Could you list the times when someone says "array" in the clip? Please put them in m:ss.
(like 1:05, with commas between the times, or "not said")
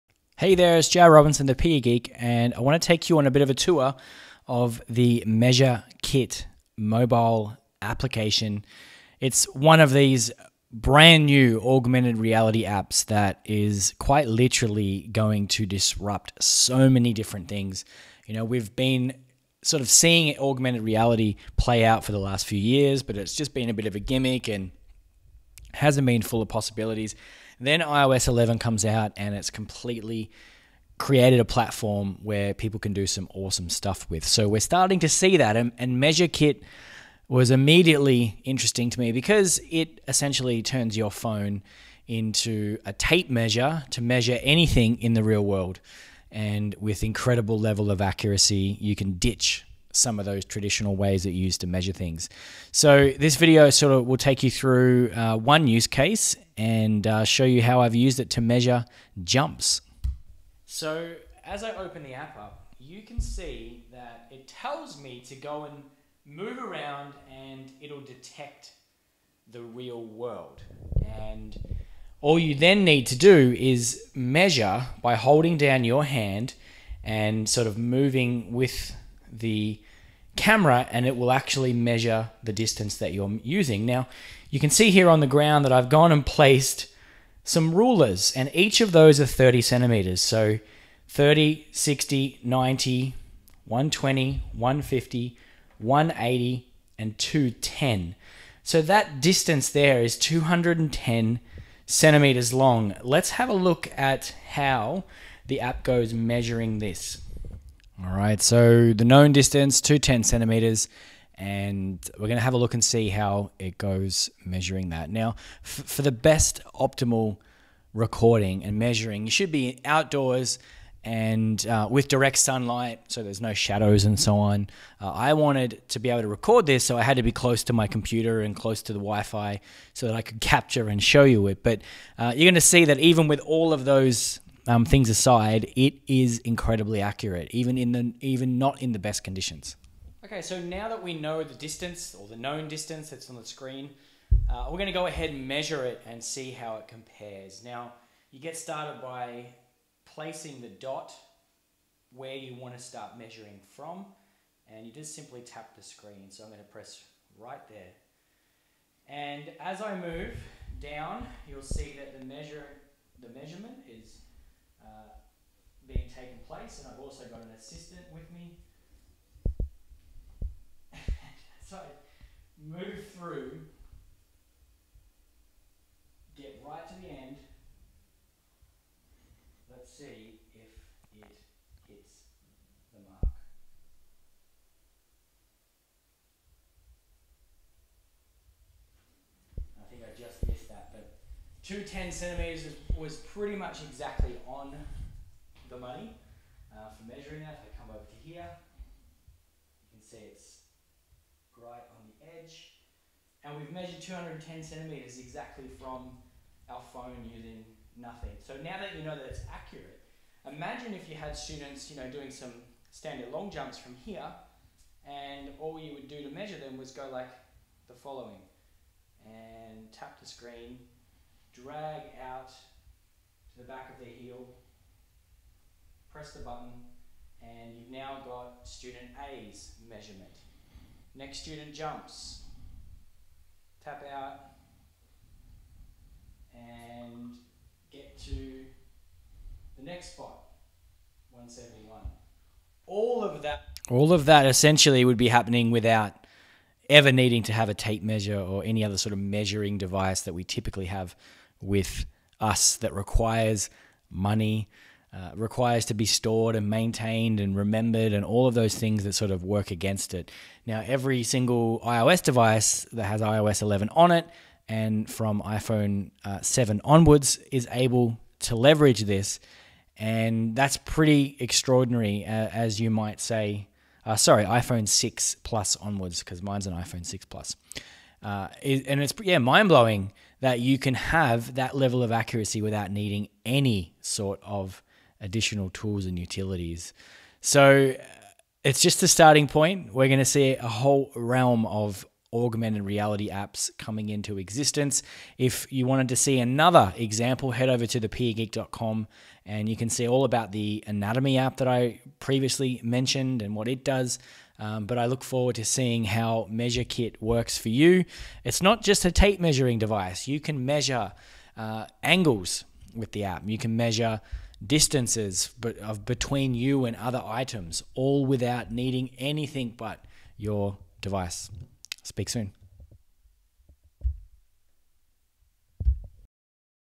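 not said.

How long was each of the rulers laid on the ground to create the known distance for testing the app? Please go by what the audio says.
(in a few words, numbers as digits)
30 centimeters.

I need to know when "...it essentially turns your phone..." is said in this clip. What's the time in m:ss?
0:39.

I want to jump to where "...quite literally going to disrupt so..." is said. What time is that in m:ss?
0:13.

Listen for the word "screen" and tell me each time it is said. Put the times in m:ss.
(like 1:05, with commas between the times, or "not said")
2:23, 2:35, 3:40.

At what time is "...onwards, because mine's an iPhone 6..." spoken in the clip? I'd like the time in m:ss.
4:35.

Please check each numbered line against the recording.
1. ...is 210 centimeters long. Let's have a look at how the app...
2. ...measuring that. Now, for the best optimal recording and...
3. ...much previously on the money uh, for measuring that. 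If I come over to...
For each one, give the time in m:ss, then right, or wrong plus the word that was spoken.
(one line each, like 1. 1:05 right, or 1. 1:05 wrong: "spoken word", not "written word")
1. 1:40 right
2. 1:54 right
3. 3:13 wrong: "exactly", not "previously".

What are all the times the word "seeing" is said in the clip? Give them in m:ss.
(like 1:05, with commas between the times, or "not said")
0:19, 5:05.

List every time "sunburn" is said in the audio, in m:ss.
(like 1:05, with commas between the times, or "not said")
not said.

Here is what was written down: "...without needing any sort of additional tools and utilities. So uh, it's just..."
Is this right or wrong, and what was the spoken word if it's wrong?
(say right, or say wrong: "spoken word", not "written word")
right.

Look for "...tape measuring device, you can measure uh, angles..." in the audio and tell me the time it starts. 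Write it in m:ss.
5:09.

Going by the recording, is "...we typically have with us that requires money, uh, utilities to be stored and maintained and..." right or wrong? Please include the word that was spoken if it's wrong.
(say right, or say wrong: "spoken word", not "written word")
wrong: "requires", not "utilities".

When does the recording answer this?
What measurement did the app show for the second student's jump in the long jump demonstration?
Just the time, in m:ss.
4:01.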